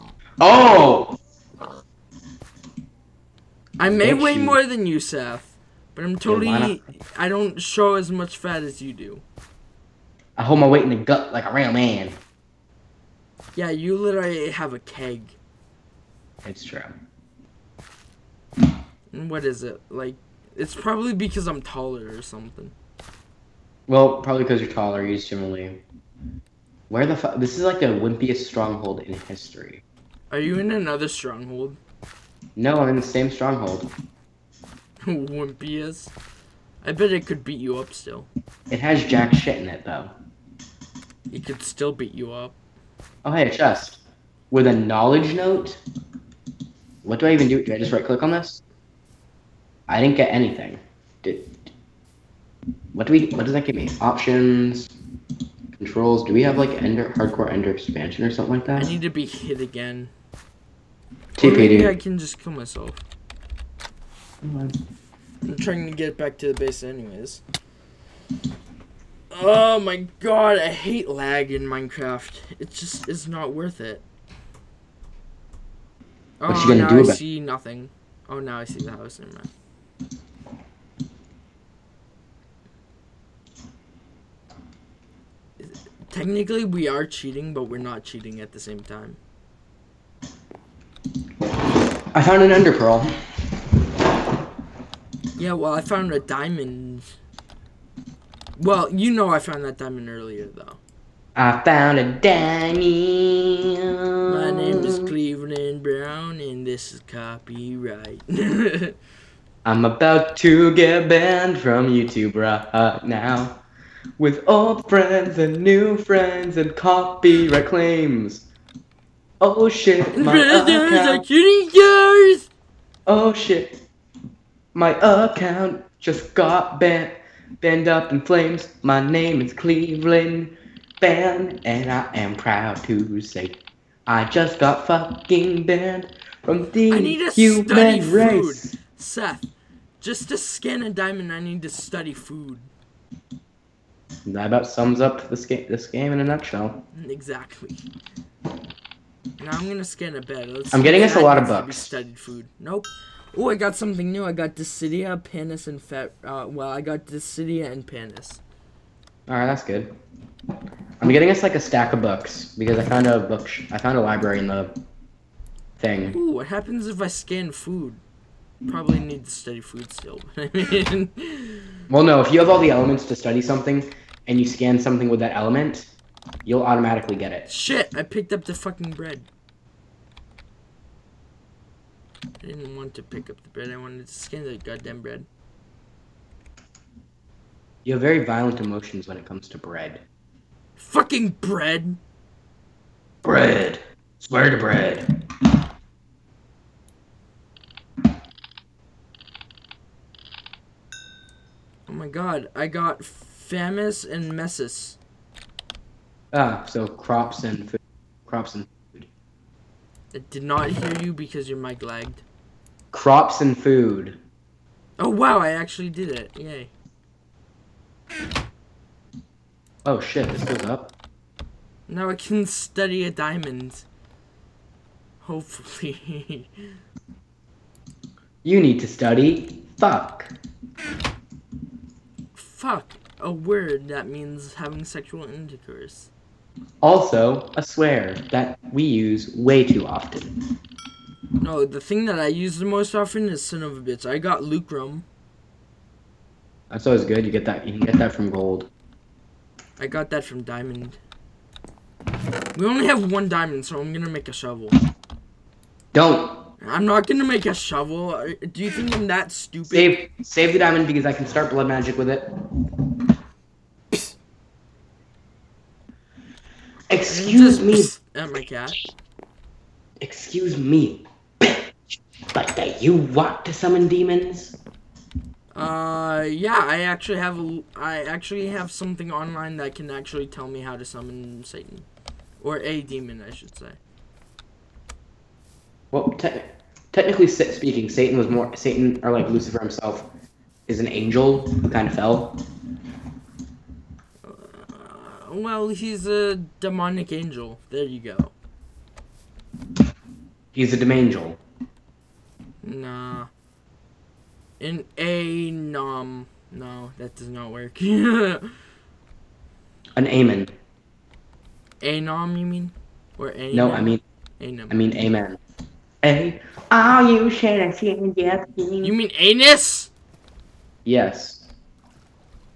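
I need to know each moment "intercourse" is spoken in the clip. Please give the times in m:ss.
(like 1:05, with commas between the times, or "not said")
3:55.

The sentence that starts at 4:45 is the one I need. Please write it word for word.
Well, technically technically speaking, Satan was more Satan or like Lucifer himself is an angel who kind of fell.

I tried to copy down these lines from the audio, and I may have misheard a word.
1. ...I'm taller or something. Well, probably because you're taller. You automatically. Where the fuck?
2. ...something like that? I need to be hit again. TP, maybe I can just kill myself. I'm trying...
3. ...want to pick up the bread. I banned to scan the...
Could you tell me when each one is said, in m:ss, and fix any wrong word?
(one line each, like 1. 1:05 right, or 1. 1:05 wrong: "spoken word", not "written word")
1. 0:21 wrong: "generally", not "automatically"
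2. 0:58 right
3. 3:02 wrong: "wanted", not "banned".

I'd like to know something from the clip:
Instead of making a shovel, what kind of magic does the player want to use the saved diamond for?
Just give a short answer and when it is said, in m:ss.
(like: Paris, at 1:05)
Blood magic, at 4:21.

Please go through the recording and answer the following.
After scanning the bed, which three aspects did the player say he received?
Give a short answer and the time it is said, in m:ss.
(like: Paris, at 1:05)
Desidia, Panis, and Fat, at 2:34.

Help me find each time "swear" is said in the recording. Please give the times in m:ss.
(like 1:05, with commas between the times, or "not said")
3:14, 3:57.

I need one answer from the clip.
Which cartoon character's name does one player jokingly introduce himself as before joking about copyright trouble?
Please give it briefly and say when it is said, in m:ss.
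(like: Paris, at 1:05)
Cleveland Brown, at 1:44.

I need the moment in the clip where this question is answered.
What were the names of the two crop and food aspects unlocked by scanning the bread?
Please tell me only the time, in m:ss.
3:23.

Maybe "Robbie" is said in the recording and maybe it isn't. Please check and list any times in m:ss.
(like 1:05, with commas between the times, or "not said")
not said.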